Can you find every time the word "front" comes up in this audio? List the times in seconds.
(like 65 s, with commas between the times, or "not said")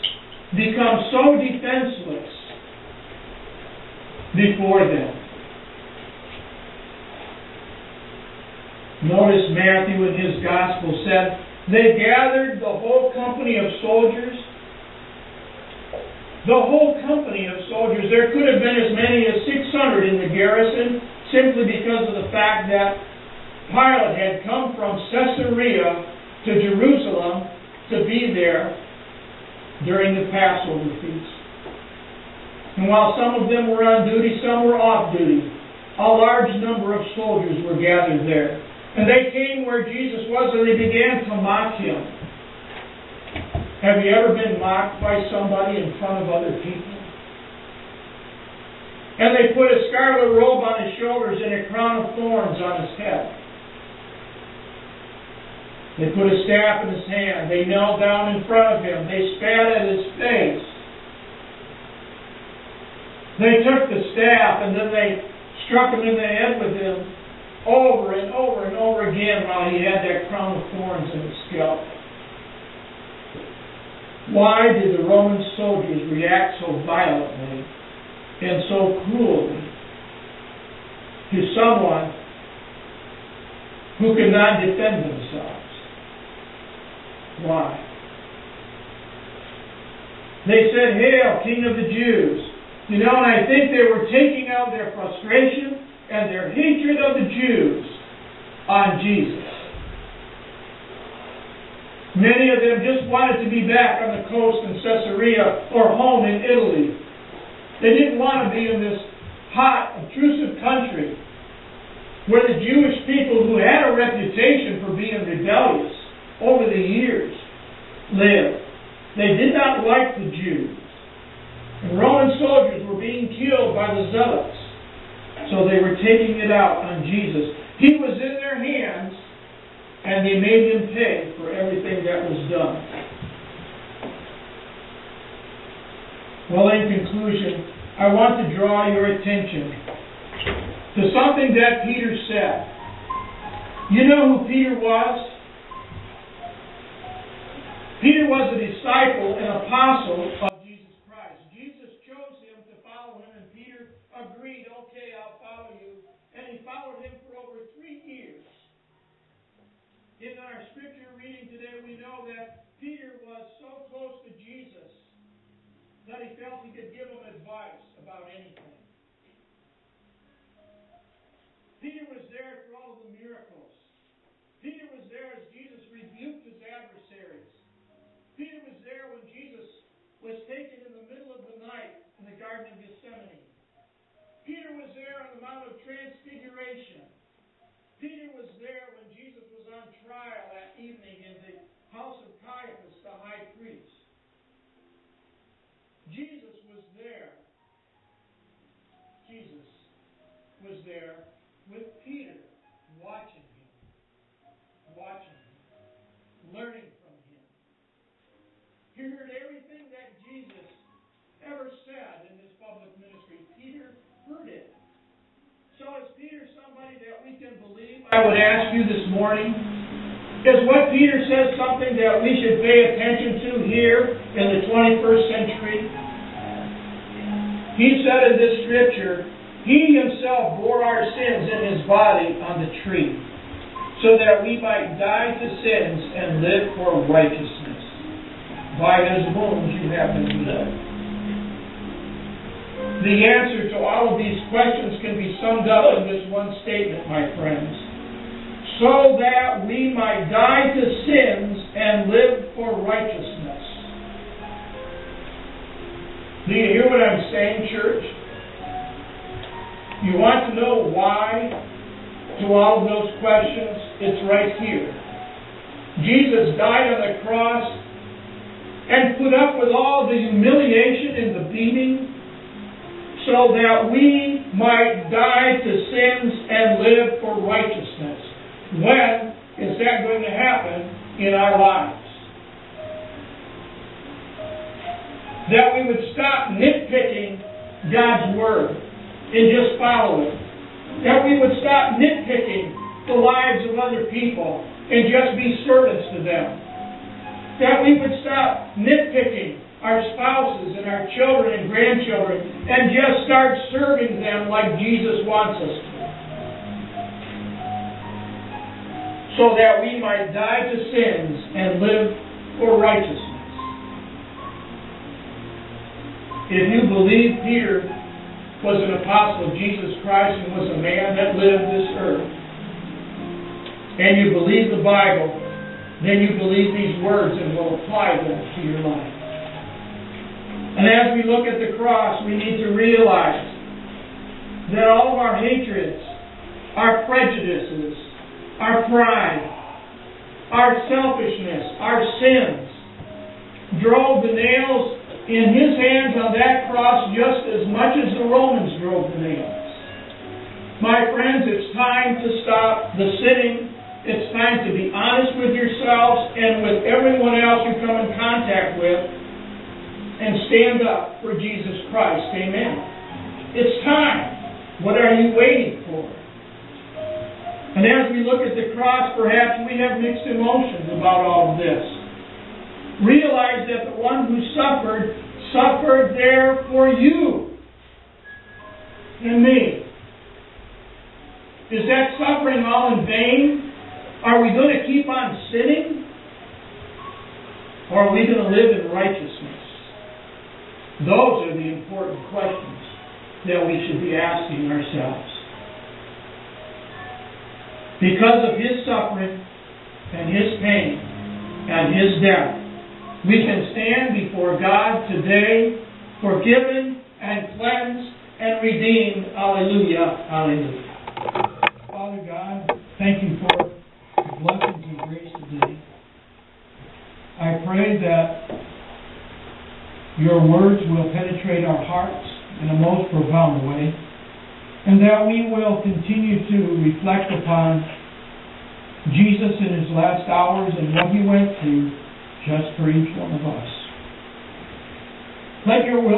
45 s, 58 s.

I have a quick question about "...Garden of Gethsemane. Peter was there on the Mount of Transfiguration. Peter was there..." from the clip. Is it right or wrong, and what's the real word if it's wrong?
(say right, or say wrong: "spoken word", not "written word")
right.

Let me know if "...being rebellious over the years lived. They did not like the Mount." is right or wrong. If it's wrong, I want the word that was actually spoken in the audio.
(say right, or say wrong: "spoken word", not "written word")
wrong: "Jews", not "Mount".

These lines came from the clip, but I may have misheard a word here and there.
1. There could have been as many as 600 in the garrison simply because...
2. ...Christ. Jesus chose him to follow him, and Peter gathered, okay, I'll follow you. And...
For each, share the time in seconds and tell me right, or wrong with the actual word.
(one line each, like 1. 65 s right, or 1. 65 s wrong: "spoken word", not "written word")
1. 18 s right
2. 151 s wrong: "agreed", not "gathered".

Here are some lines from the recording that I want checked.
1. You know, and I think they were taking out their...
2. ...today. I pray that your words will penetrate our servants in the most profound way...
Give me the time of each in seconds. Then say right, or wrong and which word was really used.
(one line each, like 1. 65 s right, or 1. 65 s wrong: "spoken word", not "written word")
1. 92 s right
2. 415 s wrong: "hearts", not "servants".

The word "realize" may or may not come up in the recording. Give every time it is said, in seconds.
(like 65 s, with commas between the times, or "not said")
332 s, 373 s.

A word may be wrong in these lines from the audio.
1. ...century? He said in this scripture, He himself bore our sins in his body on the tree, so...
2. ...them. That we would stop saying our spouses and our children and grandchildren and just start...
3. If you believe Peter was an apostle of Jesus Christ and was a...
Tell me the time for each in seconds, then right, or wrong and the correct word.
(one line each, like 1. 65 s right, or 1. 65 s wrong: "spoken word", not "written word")
1. 225 s right
2. 296 s wrong: "nitpicking", not "saying"
3. 316 s right.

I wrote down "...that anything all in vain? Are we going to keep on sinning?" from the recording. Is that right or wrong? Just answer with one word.
wrong.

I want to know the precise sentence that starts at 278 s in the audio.
When is that going to happen in our lives?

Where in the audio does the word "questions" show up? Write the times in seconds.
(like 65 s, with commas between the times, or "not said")
244 s, 263 s, 392 s.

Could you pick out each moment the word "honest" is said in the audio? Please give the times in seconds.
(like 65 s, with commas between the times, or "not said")
354 s.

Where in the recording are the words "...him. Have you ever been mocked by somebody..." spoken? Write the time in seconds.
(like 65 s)
41 s.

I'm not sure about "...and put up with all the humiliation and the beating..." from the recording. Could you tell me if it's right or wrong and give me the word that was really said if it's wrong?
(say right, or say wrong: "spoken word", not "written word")
right.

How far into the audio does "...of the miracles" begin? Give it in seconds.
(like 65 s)
173 s.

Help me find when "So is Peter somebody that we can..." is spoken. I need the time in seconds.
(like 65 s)
215 s.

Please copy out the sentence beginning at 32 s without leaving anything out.
And while some of them were on duty, some were off duty, a large number of soldiers were gathered there.